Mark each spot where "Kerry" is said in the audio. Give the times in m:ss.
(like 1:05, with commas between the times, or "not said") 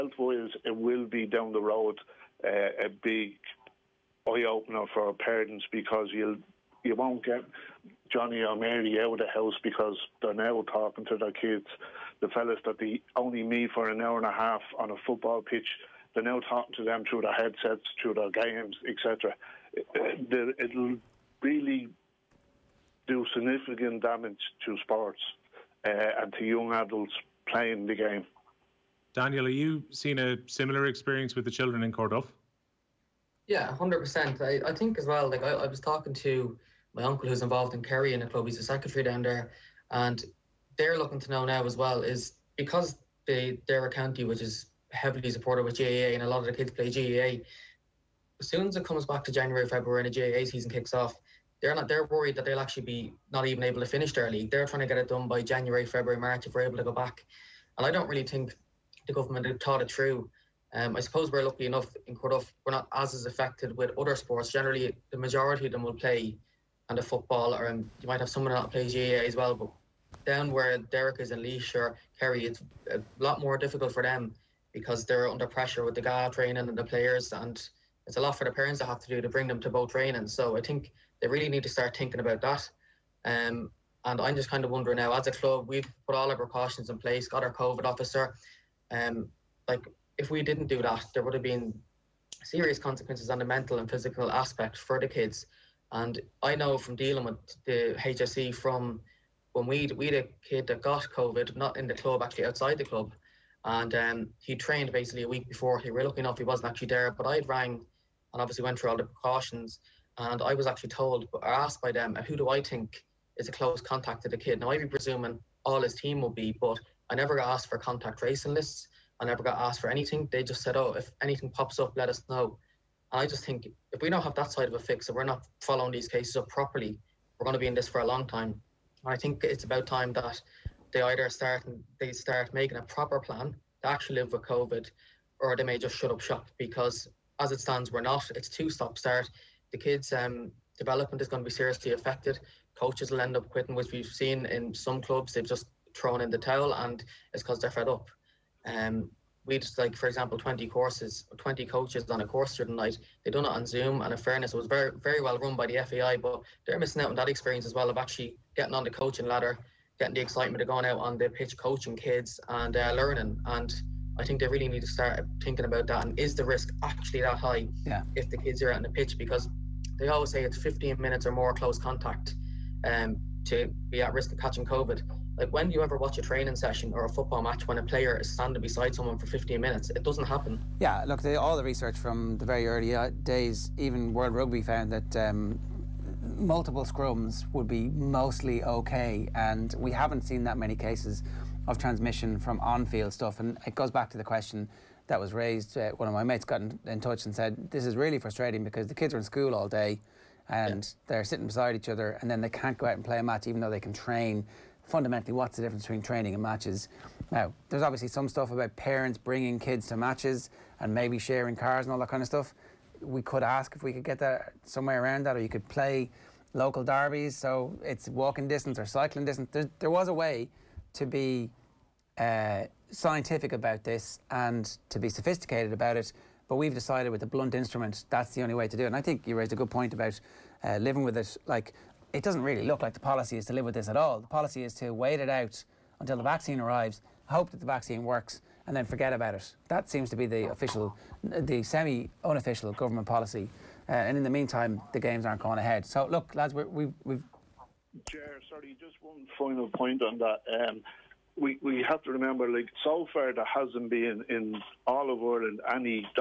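0:37, 1:12.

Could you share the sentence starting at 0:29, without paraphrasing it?
Daniel, have you seen a similar experience with the children in Corduff?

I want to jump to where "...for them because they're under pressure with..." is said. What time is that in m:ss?
1:13.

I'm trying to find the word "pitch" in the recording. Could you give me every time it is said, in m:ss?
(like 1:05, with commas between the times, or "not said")
0:15, 2:41, 2:48.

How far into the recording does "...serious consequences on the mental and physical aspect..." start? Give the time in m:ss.
1:32.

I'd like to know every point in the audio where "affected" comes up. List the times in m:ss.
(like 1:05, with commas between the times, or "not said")
1:03, 2:21.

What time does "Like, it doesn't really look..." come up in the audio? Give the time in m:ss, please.
3:51.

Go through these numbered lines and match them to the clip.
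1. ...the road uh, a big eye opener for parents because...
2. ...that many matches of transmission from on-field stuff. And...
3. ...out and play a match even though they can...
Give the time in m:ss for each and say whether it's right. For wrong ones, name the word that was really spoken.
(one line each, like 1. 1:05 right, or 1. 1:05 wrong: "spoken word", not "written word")
1. 0:01 right
2. 3:10 wrong: "cases", not "matches"
3. 3:22 right.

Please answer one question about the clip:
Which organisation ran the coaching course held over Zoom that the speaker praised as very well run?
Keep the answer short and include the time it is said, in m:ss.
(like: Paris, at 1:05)
FAI, at 2:35.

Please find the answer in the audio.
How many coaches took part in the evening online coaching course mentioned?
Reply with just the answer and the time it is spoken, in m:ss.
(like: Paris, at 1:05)
20, at 2:31.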